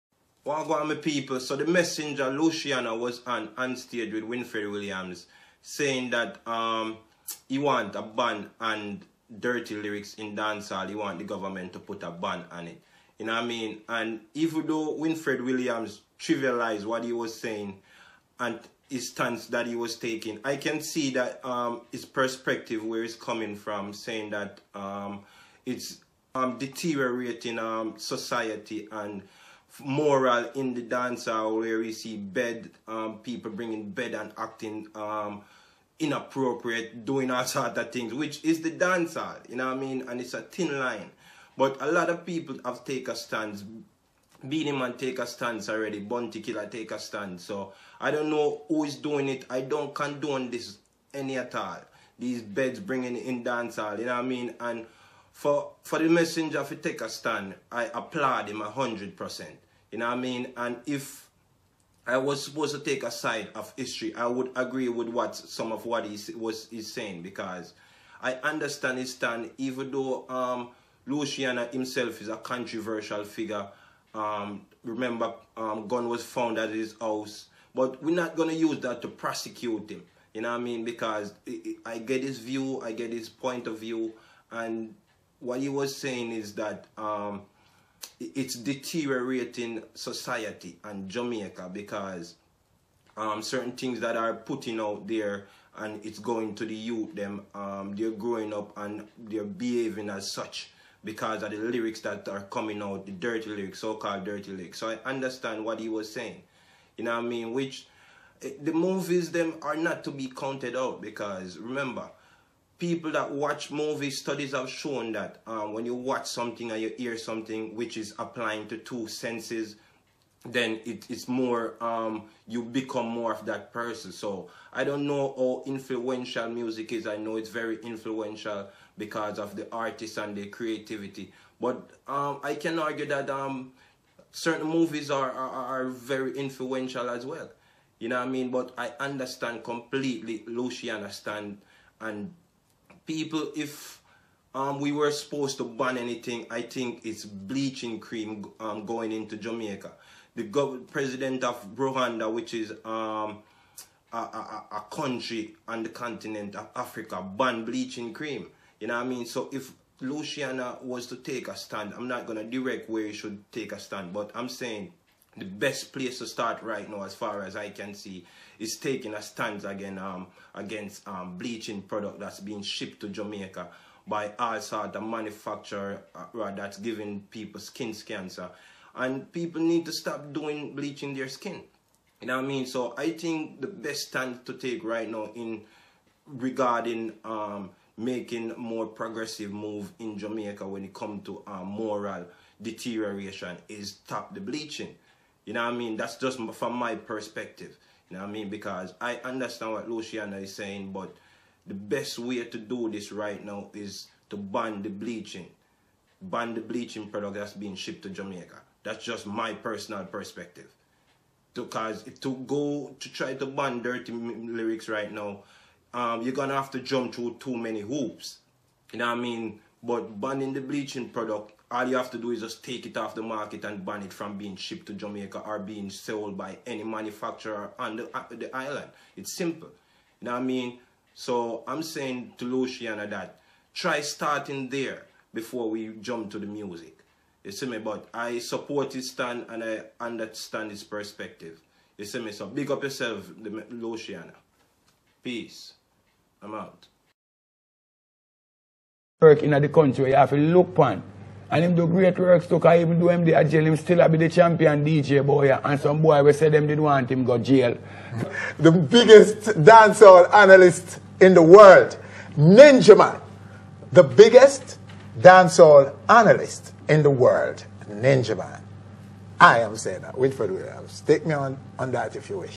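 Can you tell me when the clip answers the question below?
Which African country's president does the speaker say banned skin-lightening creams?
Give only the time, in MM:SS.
02:31.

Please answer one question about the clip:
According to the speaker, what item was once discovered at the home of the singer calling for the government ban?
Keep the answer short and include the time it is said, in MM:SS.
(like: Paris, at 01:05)
gun, at 01:15.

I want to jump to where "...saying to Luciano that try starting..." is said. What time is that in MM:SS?
03:51.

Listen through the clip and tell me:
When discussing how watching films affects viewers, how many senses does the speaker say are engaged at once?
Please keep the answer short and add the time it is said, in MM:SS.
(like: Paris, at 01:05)
2, at 01:58.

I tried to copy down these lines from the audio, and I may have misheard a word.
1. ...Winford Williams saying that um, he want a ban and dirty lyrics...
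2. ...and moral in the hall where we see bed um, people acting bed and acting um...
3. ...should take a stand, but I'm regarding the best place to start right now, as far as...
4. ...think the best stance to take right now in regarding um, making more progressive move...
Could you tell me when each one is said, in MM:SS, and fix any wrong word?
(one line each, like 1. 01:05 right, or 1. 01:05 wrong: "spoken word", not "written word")
1. 00:04 right
2. 00:28 wrong: "bringing", not "acting"
3. 02:43 wrong: "saying", not "regarding"
4. 03:03 right.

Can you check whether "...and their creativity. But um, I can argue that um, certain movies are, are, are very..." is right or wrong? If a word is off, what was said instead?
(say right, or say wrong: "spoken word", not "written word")
right.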